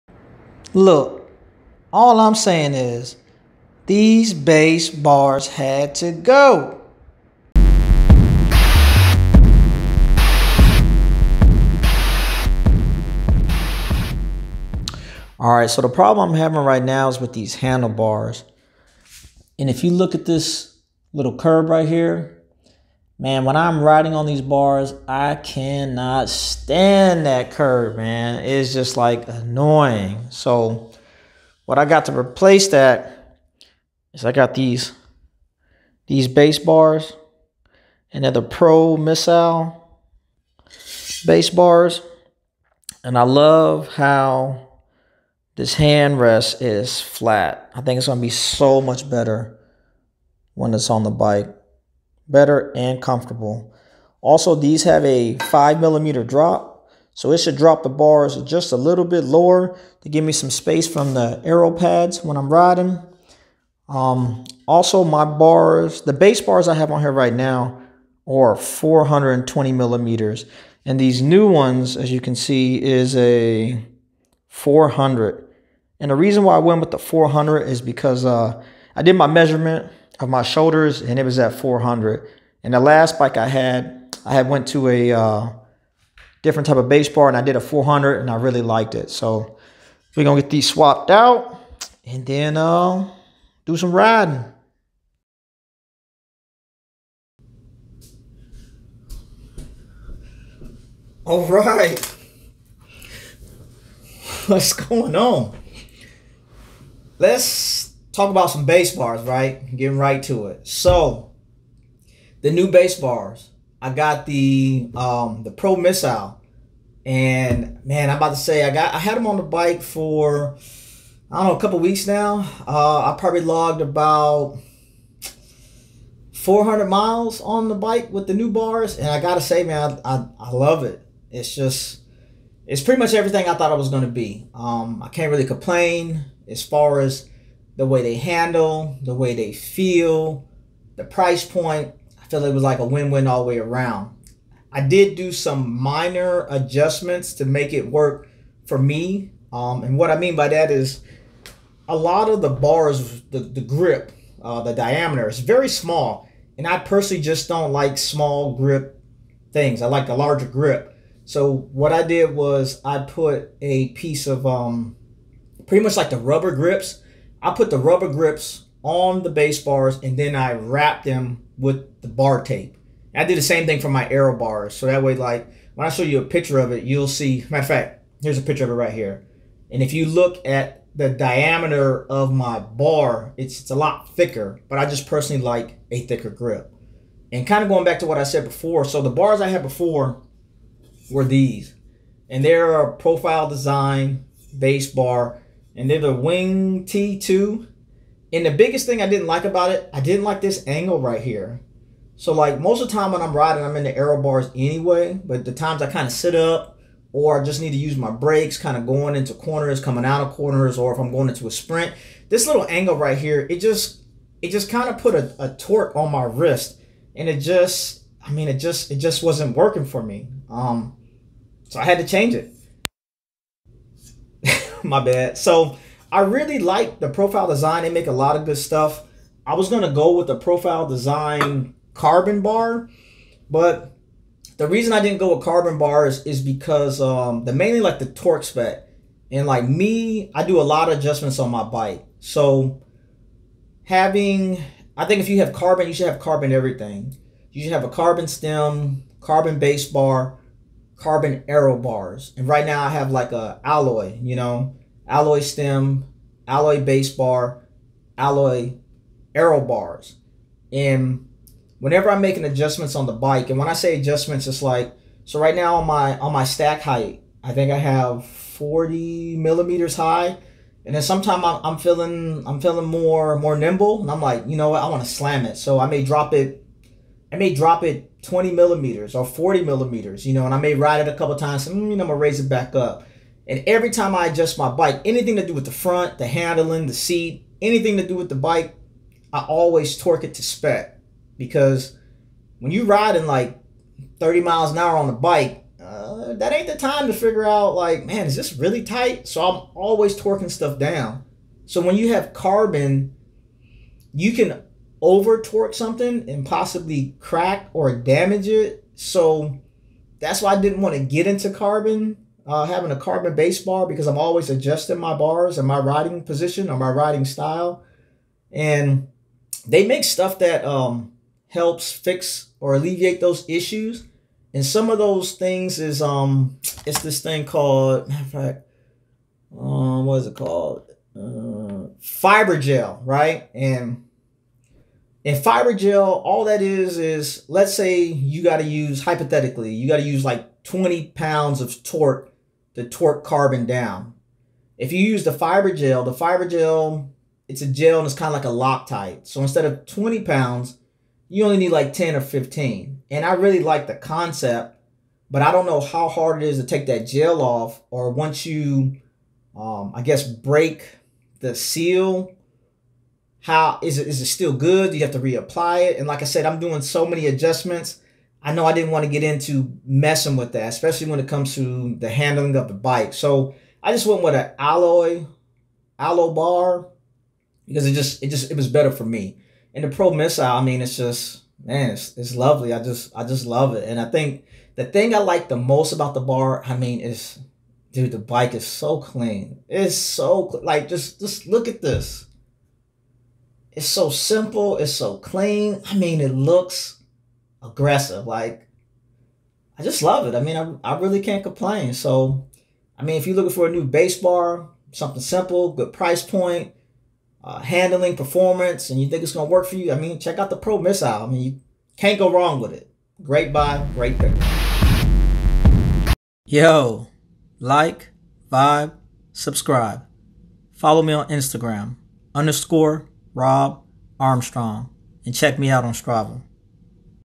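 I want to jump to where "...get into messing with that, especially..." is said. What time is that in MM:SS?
06:09.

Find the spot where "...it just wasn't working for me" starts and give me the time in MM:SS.
03:38.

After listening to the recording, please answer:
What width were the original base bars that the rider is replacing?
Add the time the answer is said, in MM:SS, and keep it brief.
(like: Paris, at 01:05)
420 millimeters, at 01:08.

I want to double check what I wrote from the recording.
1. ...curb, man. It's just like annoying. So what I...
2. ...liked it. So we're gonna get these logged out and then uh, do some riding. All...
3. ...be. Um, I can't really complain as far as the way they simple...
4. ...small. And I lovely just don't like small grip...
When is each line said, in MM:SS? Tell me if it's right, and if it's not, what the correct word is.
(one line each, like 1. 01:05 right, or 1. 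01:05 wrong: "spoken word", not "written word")
1. 00:27 right
2. 01:28 wrong: "swapped", not "logged"
3. 02:14 wrong: "handle", not "simple"
4. 02:35 wrong: "personally", not "lovely".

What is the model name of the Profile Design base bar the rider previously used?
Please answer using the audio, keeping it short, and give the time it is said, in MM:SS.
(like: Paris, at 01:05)
Wing T2, at 03:16.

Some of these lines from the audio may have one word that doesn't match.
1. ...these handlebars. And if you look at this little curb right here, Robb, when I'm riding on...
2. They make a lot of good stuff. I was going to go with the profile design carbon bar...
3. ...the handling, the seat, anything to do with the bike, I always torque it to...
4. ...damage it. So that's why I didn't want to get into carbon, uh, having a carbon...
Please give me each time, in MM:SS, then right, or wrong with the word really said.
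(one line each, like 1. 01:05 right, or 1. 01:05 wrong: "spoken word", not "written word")
1. 00:17 wrong: "Man", not "Robb"
2. 03:47 right
3. 04:46 right
4. 05:07 right.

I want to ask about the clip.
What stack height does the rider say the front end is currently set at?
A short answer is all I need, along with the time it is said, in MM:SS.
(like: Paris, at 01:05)
40 millimeters, at 04:28.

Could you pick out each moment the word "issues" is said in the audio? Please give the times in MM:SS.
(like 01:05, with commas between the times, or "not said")
05:23.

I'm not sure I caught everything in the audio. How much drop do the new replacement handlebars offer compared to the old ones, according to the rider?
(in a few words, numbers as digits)
5 millimeters.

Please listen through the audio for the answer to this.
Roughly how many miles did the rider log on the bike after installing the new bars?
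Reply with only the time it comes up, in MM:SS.
02:06.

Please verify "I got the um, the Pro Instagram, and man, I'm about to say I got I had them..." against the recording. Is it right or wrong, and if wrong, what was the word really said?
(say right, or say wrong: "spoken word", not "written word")
wrong: "Missile", not "Instagram".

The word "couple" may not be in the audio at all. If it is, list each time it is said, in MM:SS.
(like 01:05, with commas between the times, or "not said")
02:01, 04:41.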